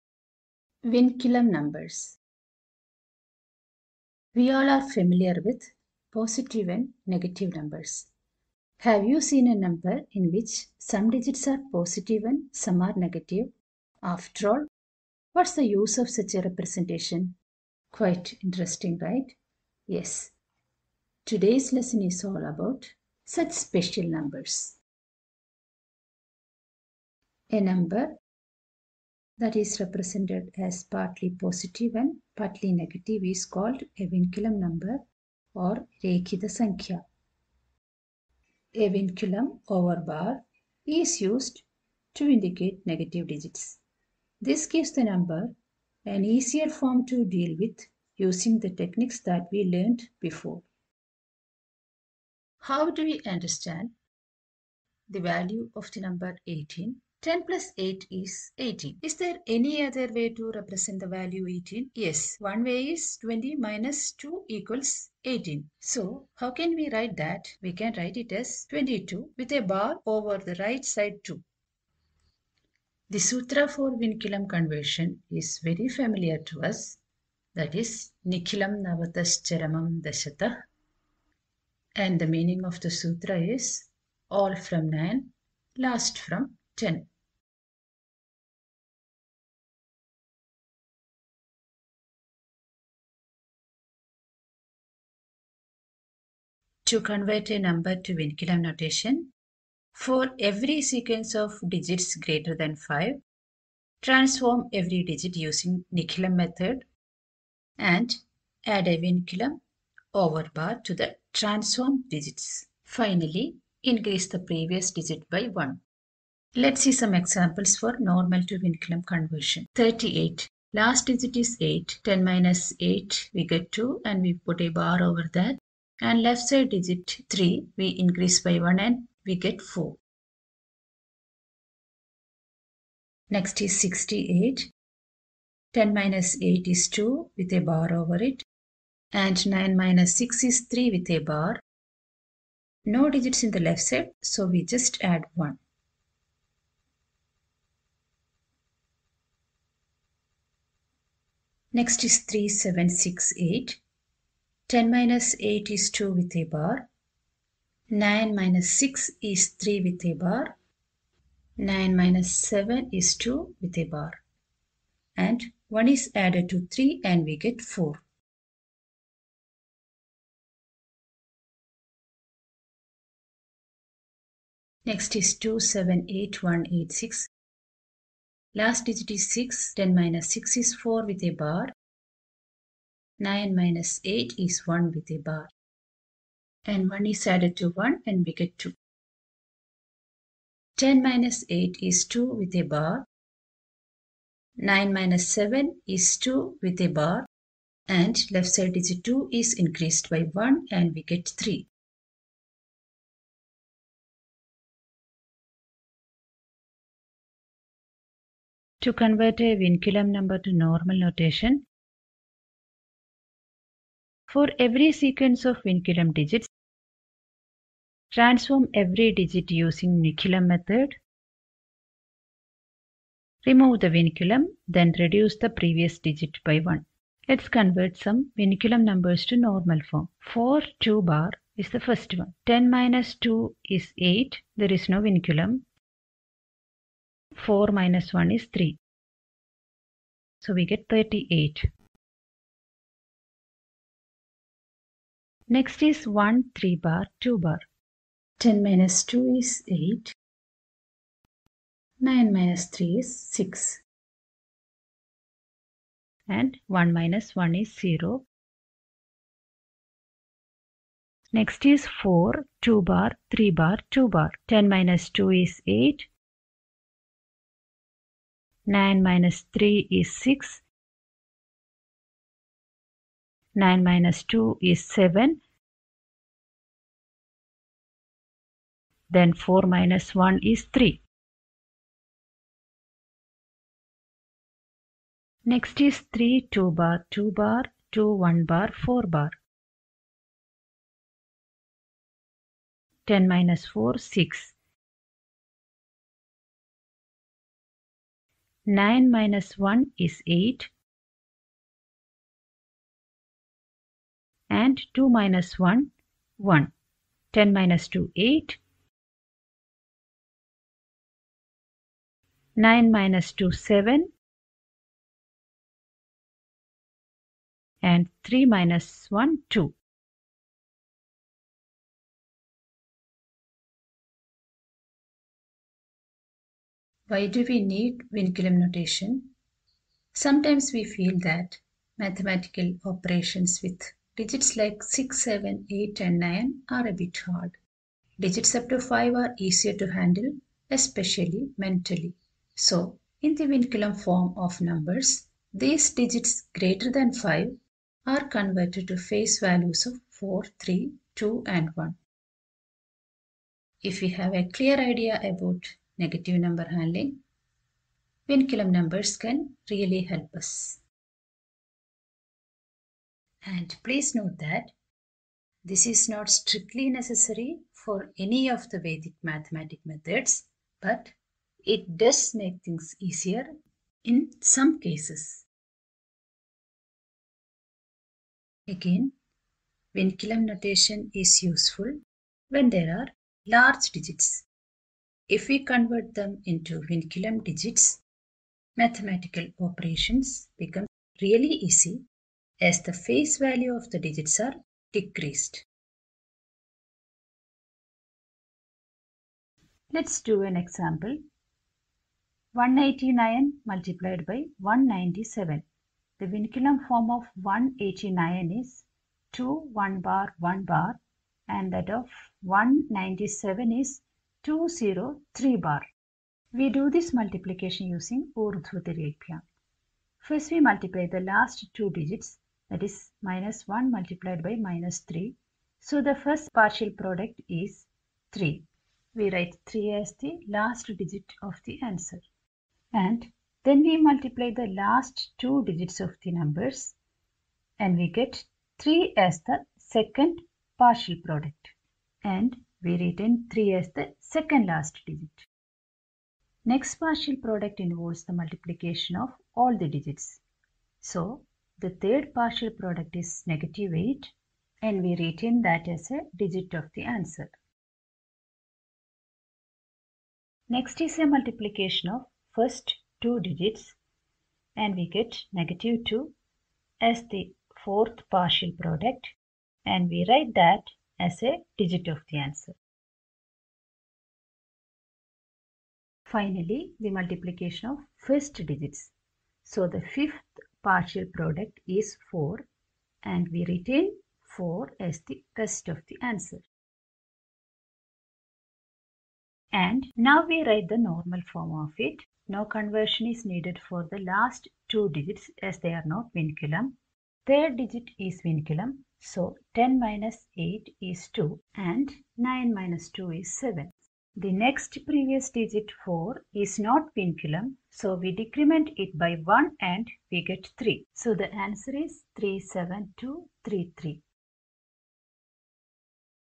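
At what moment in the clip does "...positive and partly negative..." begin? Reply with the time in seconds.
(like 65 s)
31 s.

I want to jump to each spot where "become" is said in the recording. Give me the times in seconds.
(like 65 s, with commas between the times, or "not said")
390 s.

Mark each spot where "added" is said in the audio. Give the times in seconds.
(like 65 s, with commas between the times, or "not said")
166 s, 187 s.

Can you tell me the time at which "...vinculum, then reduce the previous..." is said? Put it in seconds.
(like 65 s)
223 s.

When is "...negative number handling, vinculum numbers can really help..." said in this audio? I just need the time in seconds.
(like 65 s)
355 s.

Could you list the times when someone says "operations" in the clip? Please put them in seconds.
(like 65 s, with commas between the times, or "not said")
332 s, 389 s.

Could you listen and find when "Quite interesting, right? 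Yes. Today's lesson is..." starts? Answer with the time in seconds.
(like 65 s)
17 s.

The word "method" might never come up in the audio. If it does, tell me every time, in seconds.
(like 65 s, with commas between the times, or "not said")
106 s, 220 s, 369 s.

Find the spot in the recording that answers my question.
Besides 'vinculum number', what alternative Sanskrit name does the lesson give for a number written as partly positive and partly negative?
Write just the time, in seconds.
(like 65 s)
36 s.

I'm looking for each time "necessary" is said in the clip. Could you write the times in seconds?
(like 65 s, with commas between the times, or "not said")
366 s.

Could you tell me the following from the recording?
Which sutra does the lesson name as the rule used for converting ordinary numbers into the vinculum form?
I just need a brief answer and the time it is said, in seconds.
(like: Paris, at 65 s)
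Nikhilam charamam Dashata, at 78 s.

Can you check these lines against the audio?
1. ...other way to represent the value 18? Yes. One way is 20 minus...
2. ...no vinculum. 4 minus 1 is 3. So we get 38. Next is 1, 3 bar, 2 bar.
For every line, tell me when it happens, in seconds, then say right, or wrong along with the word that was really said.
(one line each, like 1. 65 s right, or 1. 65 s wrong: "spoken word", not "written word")
1. 59 s right
2. 234 s right.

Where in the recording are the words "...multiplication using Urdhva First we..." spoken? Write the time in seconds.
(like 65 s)
417 s.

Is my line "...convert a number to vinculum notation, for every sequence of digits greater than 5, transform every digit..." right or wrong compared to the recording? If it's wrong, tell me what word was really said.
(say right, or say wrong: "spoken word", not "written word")
right.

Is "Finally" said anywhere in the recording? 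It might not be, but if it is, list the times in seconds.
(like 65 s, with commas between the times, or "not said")
112 s, 476 s.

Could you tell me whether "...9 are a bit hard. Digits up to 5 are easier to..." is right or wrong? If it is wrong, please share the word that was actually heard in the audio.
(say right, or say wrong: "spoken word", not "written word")
right.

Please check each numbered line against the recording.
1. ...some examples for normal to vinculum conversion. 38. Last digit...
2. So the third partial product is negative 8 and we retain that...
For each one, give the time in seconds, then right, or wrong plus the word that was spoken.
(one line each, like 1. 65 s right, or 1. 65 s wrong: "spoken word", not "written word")
1. 116 s right
2. 451 s right.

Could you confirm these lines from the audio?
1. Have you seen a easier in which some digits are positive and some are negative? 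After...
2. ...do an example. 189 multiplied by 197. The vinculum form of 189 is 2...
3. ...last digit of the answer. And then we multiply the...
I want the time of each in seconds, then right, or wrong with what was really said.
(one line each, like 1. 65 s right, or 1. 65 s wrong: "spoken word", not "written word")
1. 8 s wrong: "number", not "easier"
2. 400 s right
3. 430 s right.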